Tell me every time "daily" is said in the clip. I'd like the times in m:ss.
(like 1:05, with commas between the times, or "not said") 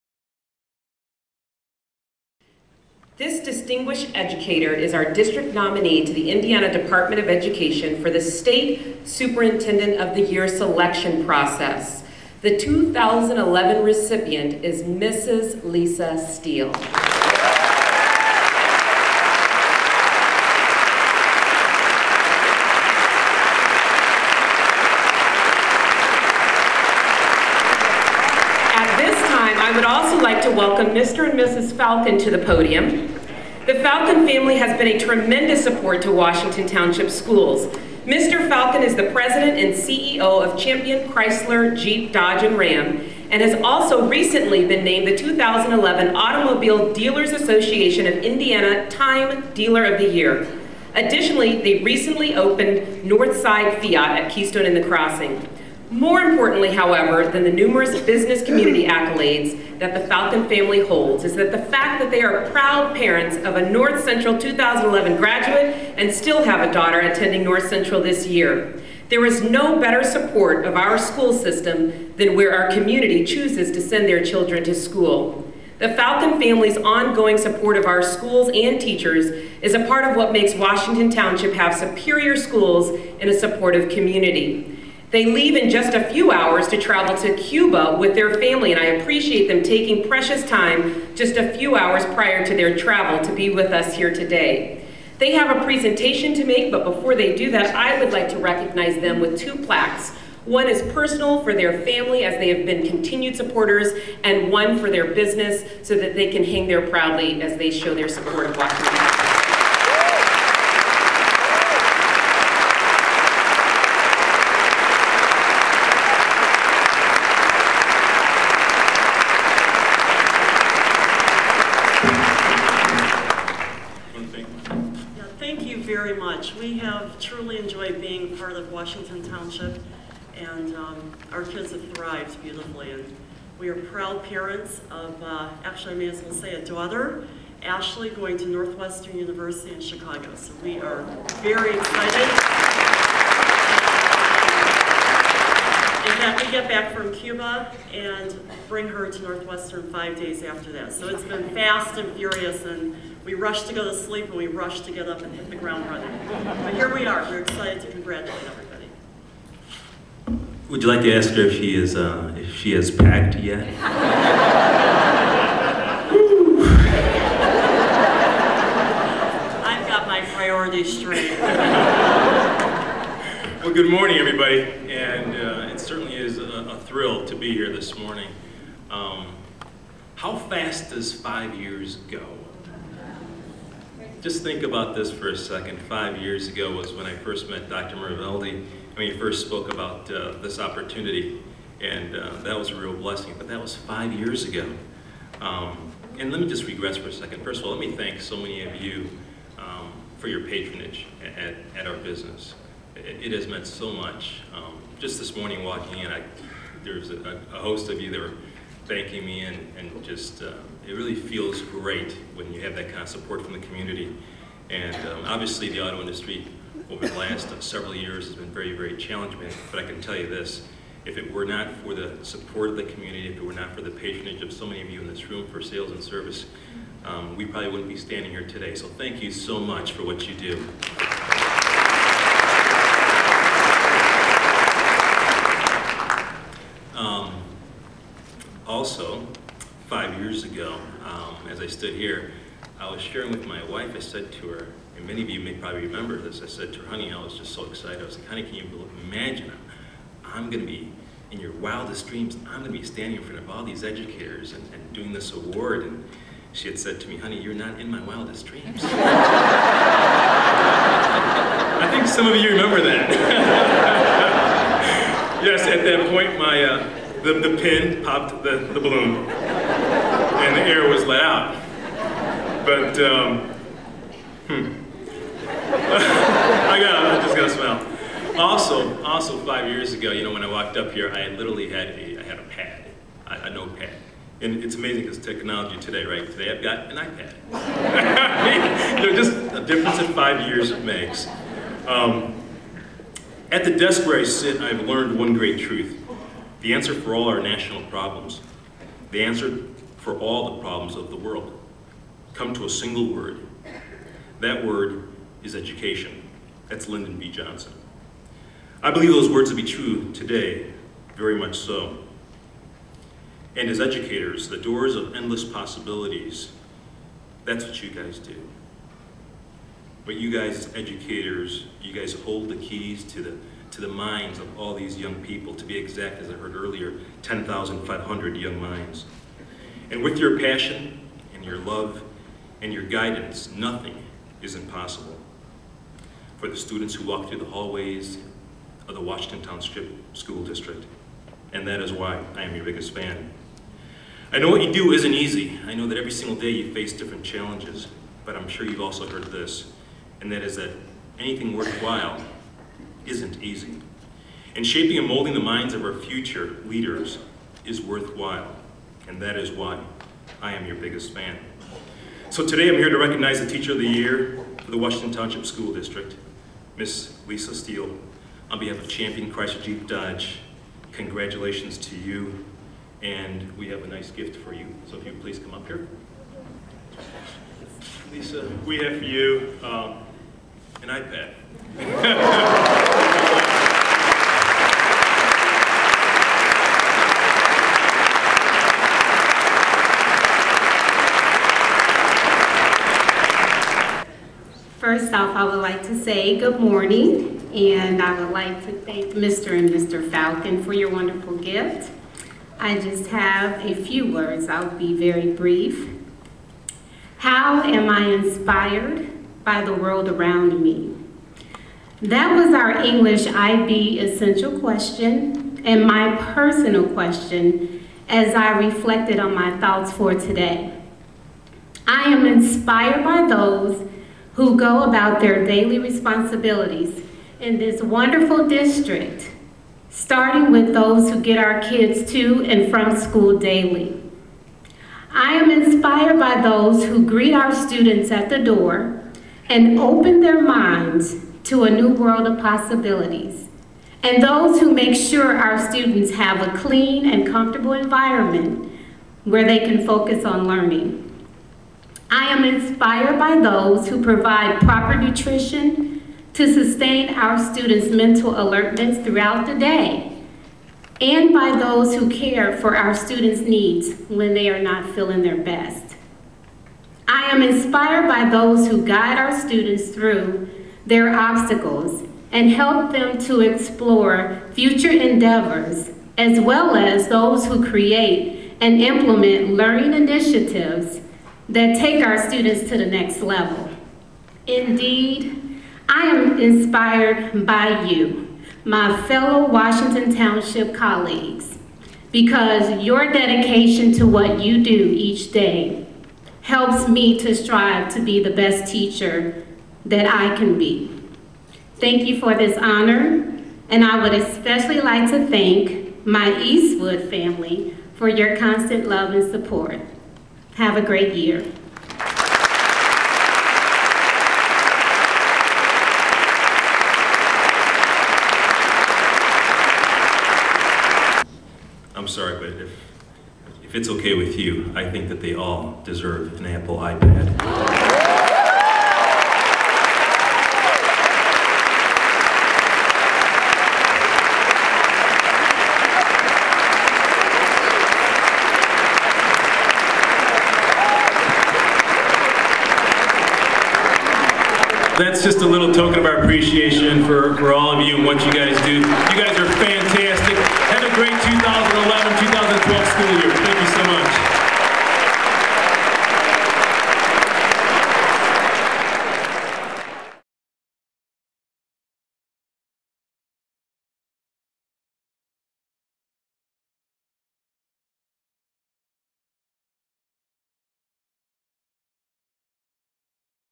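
7:05, 7:13.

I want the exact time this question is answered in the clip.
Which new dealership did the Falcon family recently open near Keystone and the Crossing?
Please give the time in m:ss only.
0:53.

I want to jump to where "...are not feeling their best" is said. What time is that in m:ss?
7:44.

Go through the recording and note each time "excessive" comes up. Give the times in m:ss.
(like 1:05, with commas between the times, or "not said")
not said.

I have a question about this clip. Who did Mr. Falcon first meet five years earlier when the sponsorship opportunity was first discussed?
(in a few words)
Dr. Miravaldi.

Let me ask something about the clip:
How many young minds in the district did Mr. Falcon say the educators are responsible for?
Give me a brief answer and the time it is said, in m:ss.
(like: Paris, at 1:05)
10,500, at 5:27.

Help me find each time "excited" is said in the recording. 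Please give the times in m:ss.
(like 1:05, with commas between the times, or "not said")
2:21, 2:37, 4:07.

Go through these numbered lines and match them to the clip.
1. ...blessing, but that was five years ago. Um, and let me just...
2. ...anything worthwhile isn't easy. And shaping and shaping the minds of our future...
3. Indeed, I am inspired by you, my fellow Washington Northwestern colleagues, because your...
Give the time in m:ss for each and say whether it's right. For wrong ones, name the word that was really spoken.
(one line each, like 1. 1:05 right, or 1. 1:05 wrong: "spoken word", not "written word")
1. 3:12 right
2. 5:51 wrong: "molding", not "shaping"
3. 8:04 wrong: "Township", not "Northwestern".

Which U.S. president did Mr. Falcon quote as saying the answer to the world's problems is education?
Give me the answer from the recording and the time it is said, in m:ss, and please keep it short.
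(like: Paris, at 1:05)
Lyndon B. Johnson, at 5:06.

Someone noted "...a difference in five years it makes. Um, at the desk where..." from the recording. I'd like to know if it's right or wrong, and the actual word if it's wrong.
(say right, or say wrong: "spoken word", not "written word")
right.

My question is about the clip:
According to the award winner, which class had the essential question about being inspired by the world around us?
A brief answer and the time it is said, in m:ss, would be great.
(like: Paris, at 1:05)
English IB, at 6:52.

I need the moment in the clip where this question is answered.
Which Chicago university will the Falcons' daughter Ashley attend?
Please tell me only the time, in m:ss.
2:18.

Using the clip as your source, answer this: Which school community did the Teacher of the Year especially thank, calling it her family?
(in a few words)
Eastwood.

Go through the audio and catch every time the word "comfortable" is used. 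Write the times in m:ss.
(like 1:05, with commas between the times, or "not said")
7:27.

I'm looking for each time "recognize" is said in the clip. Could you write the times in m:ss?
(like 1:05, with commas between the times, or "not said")
1:38, 6:02.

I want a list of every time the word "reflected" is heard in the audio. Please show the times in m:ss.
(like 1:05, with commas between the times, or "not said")
6:58.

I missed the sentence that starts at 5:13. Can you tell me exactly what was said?
And as educators, the doors of endless possibilities, that's what you guys do.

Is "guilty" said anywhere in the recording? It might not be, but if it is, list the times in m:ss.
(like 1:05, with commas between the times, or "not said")
not said.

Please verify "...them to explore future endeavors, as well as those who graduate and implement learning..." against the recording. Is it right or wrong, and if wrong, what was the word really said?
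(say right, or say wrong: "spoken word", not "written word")
wrong: "create", not "graduate".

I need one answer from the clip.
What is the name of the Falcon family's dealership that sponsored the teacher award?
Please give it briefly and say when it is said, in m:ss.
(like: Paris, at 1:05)
Champion Chrysler Jeep Dodge and Ram, at 0:40.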